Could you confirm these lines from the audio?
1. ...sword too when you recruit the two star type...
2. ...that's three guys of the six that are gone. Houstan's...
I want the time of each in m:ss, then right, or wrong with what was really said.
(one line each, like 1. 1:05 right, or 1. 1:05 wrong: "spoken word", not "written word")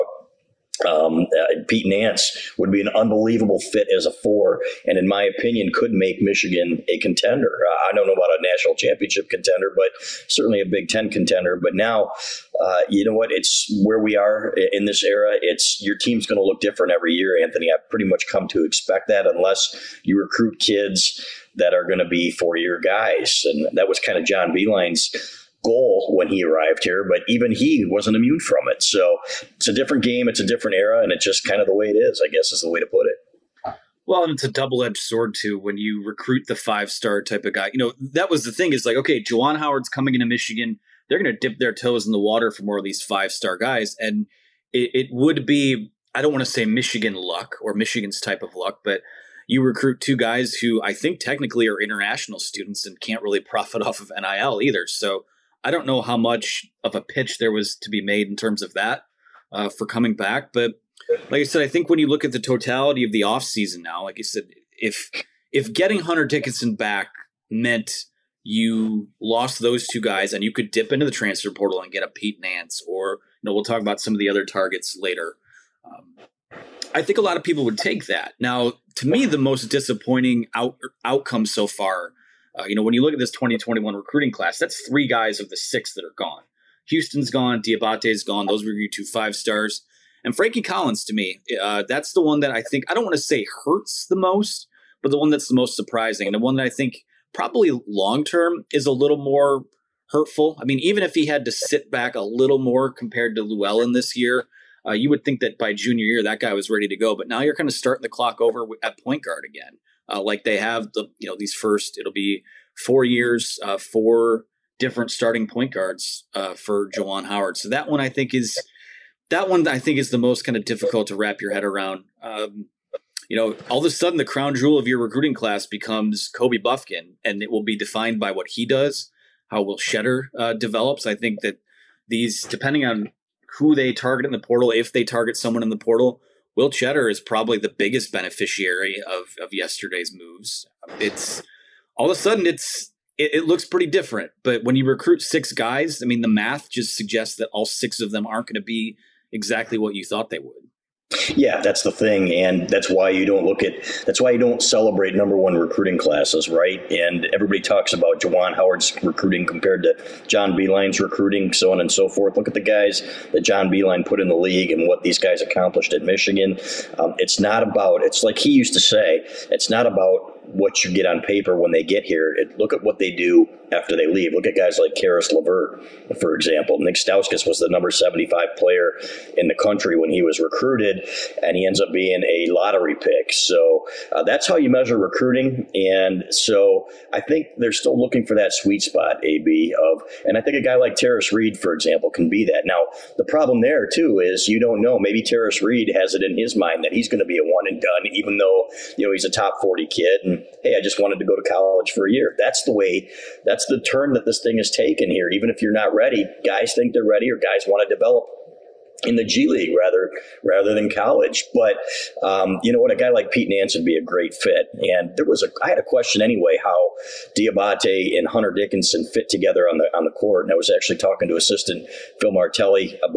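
1. 0:34 wrong: "five", not "two"
2. 1:24 right.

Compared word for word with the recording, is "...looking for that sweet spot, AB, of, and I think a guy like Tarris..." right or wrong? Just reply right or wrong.
right.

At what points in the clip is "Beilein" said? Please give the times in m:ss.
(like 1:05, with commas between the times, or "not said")
0:24, 2:40.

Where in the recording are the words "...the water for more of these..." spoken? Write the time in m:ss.
0:42.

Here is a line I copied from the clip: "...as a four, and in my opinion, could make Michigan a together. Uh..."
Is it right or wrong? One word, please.
wrong.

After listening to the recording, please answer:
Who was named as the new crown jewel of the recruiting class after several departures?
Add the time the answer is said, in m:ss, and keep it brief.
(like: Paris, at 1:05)
Kobe Bufkin, at 2:06.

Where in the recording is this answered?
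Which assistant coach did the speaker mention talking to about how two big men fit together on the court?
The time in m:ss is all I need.
3:42.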